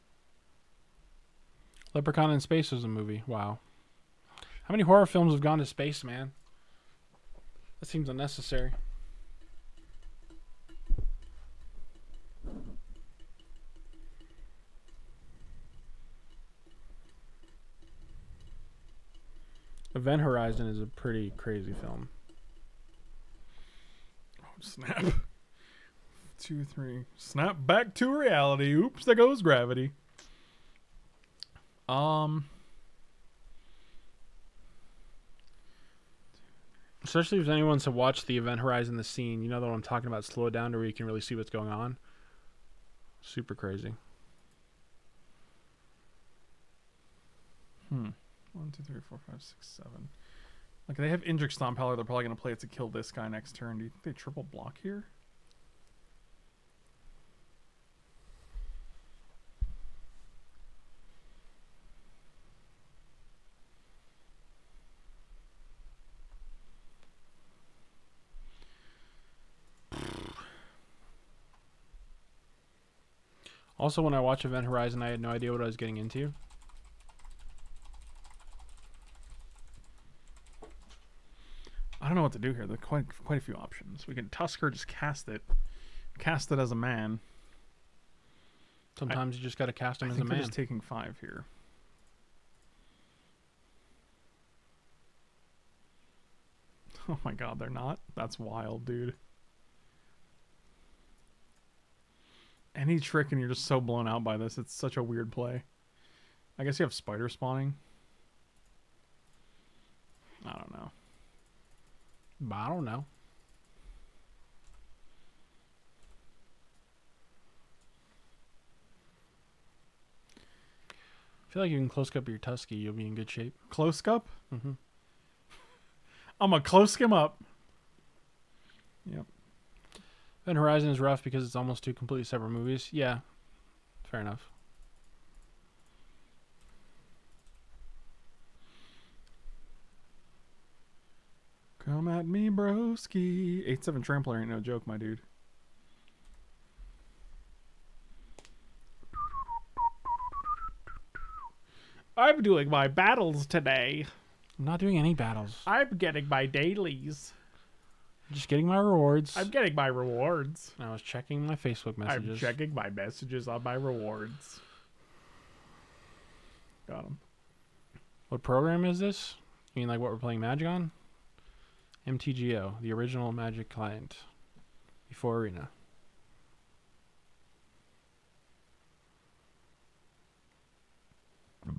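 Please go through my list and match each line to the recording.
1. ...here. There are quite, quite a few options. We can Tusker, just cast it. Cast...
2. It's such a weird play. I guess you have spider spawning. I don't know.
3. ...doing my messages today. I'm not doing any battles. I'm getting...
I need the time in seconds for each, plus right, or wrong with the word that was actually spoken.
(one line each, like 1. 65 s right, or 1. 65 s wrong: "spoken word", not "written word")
1. 82 s right
2. 104 s right
3. 152 s wrong: "battles", not "messages".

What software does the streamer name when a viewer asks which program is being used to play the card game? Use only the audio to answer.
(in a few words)
MTGO.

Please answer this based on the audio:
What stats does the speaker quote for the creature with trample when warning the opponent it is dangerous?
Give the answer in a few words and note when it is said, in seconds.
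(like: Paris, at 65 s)
8-7, at 143 s.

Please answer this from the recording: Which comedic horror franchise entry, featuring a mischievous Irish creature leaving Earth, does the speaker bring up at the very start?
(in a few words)
Leprechaun in Space.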